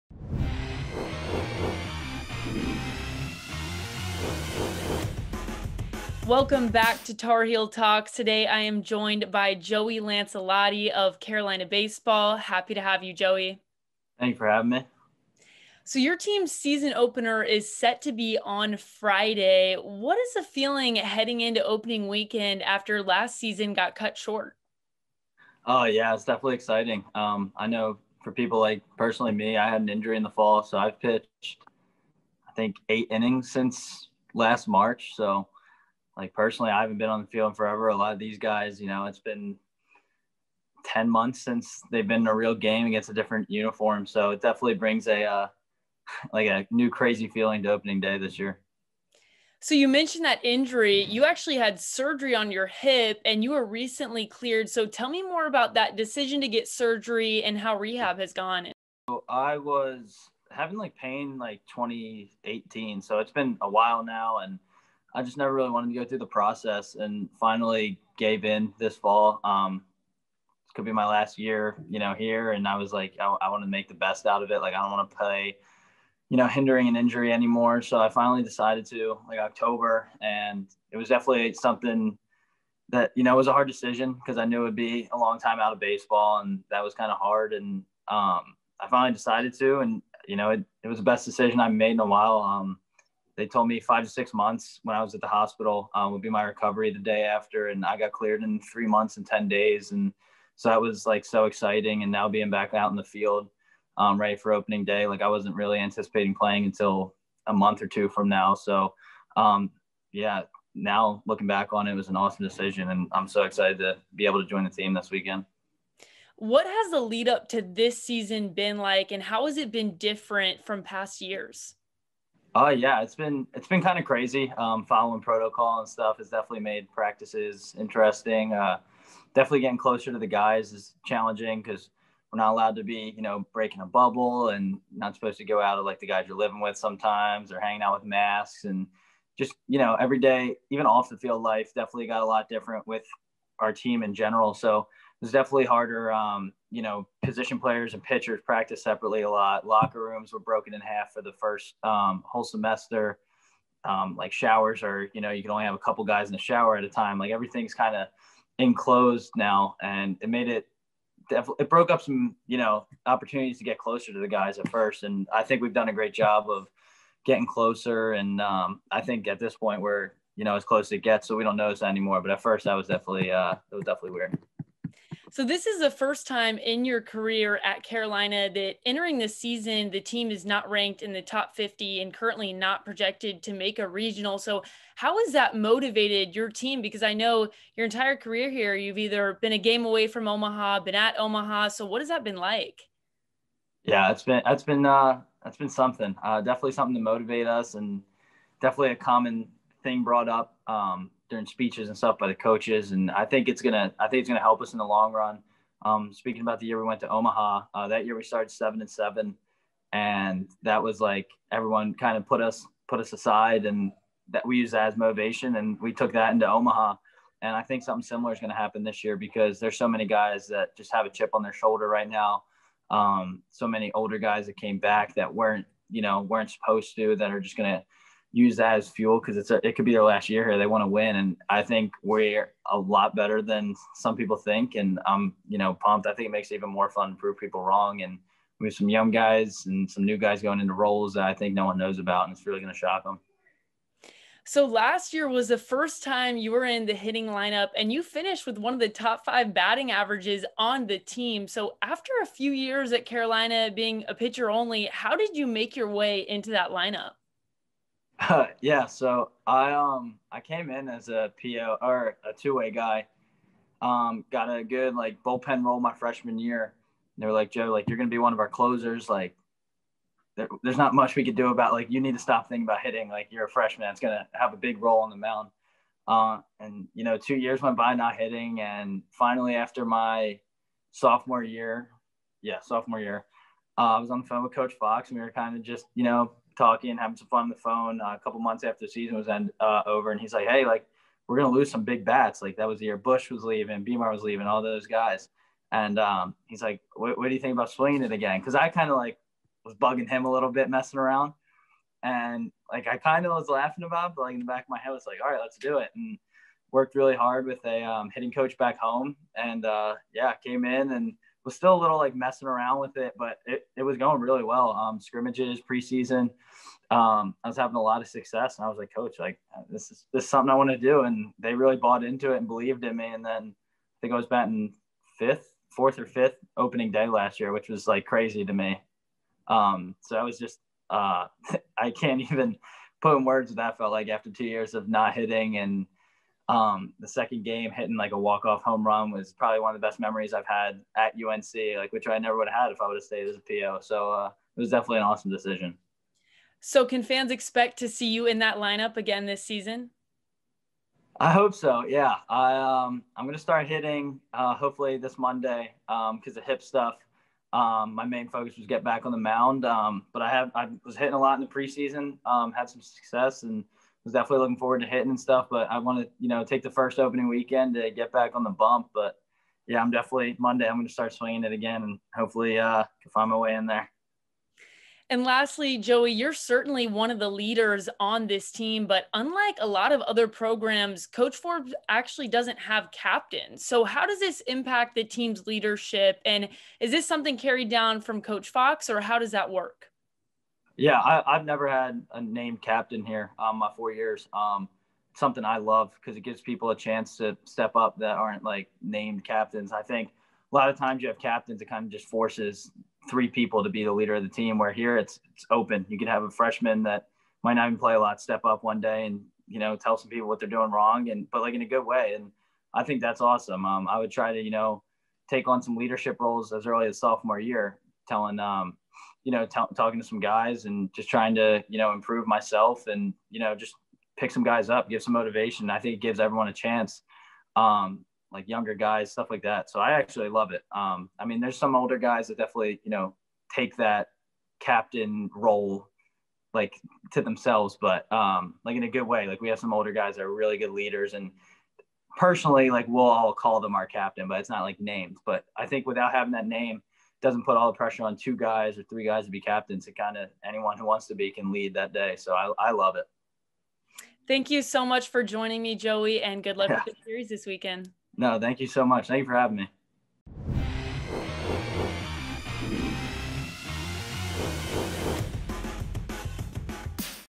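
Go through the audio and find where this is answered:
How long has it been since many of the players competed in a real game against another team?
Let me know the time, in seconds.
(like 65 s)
40 s.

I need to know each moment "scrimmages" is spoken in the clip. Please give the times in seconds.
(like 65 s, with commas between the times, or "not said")
314 s.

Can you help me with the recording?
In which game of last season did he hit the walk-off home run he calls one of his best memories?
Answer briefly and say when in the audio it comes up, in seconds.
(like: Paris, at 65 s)
The second game, at 336 s.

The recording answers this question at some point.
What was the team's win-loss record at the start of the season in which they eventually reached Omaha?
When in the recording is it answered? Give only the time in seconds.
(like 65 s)
208 s.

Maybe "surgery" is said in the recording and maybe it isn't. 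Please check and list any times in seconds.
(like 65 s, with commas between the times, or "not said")
51 s, 56 s.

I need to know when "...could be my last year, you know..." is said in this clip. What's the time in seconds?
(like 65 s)
70 s.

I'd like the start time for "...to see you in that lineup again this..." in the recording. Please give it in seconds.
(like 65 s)
347 s.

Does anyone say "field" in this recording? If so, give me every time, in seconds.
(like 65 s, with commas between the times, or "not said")
37 s, 103 s, 141 s.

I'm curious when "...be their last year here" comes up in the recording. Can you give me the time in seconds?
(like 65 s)
229 s.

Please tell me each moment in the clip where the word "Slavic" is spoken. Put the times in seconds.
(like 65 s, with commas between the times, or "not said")
not said.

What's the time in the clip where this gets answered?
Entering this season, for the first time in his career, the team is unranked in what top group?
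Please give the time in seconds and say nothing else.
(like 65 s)
181 s.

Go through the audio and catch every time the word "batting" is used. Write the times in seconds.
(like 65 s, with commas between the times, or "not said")
249 s, 324 s.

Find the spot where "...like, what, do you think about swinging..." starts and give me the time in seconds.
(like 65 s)
296 s.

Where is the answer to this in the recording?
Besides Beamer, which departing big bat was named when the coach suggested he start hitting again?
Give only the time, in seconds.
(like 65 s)
292 s.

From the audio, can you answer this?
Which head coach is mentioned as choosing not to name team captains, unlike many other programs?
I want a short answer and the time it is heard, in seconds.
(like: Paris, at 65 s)
Coach Forbes, at 381 s.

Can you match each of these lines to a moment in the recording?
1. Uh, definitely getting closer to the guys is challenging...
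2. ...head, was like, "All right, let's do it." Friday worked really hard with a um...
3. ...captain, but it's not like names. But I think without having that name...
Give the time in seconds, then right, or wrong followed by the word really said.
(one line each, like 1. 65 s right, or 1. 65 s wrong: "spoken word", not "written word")
1. 128 s right
2. 304 s wrong: "And", not "Friday"
3. 443 s right.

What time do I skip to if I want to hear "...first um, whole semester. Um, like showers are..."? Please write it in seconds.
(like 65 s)
151 s.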